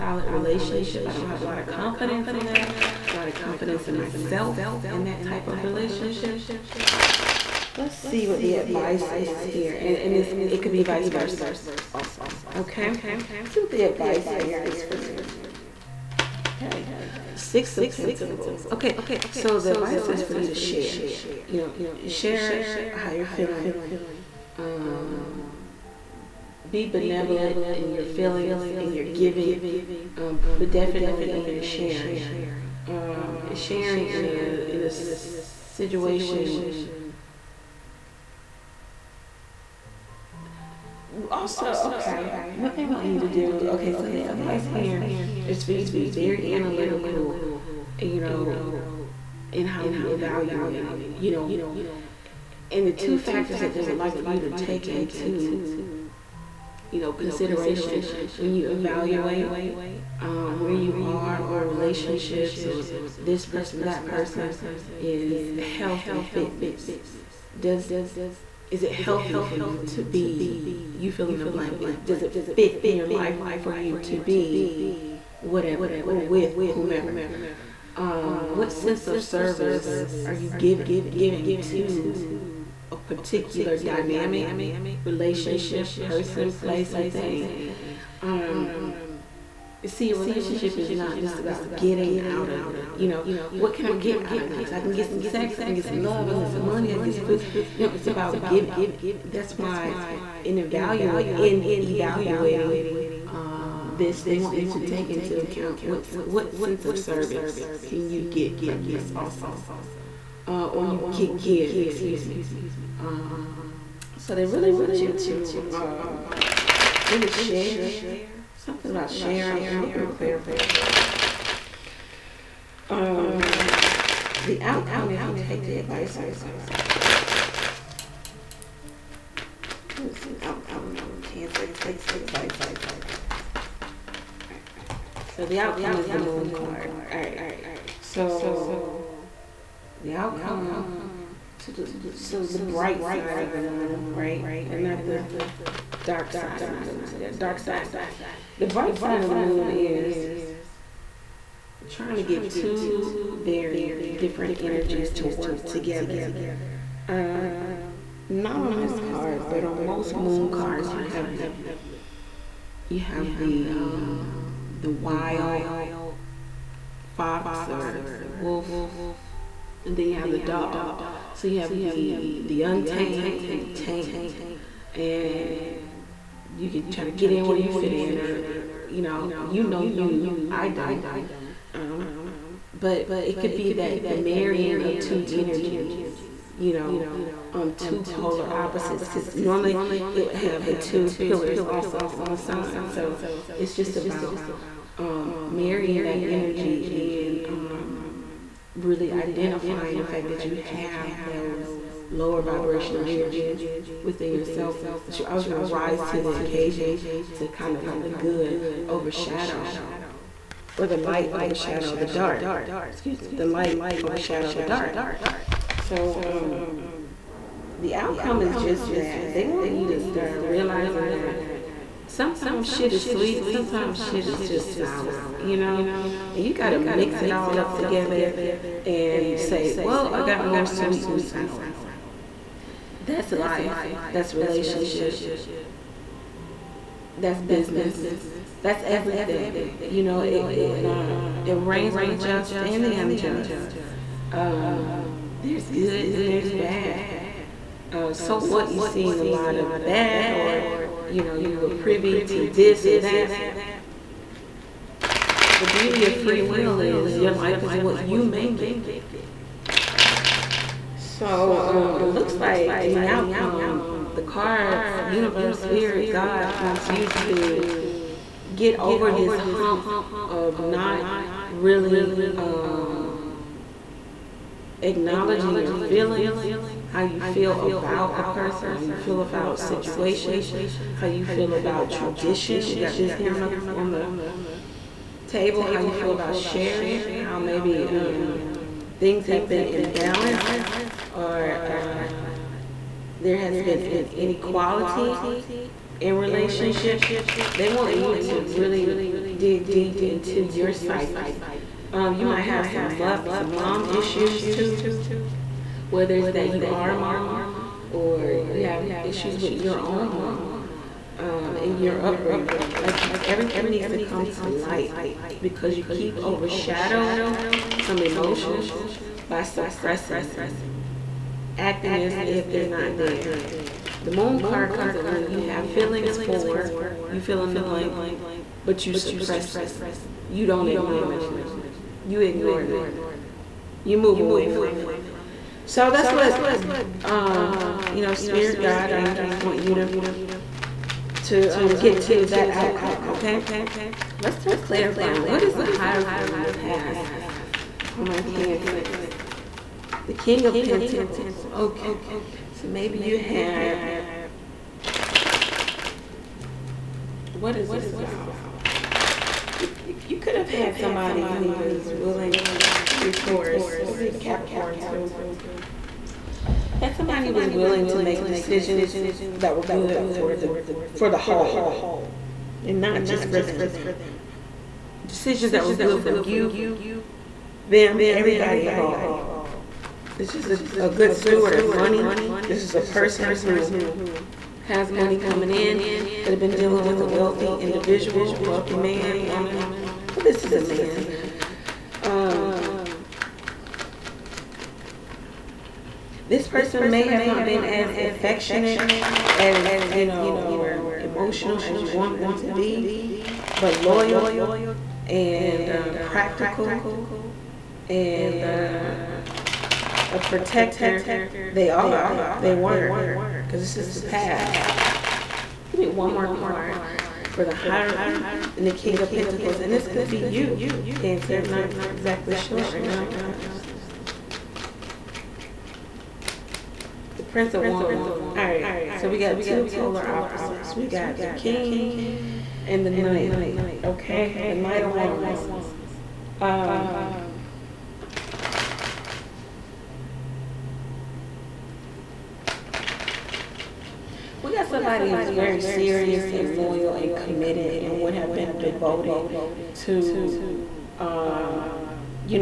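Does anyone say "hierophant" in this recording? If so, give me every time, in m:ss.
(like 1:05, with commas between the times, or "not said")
5:45, 6:57.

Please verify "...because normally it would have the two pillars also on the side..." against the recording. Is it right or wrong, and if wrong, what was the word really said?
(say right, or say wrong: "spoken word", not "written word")
right.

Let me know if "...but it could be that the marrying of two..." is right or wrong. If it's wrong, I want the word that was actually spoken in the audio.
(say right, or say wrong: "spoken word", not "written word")
right.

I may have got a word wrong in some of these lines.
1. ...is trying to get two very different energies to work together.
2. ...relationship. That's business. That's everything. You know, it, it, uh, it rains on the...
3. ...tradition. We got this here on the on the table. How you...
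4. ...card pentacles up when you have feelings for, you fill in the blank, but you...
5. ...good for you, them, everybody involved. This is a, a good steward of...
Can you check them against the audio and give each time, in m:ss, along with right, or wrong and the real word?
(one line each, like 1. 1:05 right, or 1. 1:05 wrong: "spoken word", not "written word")
1. 2:29 right
2. 3:54 right
3. 4:41 right
4. 5:24 wrong: "comes", not "pentacles"
5. 6:15 right.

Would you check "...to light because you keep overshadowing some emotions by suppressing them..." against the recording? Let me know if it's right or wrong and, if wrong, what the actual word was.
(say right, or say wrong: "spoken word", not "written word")
right.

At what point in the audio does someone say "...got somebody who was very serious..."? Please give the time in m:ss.
7:24.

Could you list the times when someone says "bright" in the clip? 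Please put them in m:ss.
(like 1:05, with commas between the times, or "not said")
2:22, 2:28.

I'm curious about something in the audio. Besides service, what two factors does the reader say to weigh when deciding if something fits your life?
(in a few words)
Health and fitness.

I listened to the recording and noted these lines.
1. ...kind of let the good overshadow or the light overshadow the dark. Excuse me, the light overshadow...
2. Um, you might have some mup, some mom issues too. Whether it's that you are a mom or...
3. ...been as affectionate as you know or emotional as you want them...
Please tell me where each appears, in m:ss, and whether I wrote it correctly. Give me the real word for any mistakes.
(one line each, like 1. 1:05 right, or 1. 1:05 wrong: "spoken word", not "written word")
1. 3:27 right
2. 5:01 right
3. 6:37 right.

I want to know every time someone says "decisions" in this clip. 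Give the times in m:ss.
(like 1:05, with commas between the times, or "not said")
6:08, 6:15.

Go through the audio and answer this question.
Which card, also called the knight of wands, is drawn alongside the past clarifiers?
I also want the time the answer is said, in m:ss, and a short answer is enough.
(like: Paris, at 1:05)
Prince of Wands, at 7:07.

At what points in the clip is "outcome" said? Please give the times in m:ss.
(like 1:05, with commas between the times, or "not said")
2:04, 2:10, 2:15, 2:20, 3:37, 4:23, 5:42.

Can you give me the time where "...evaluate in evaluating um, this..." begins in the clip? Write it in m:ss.
1:40.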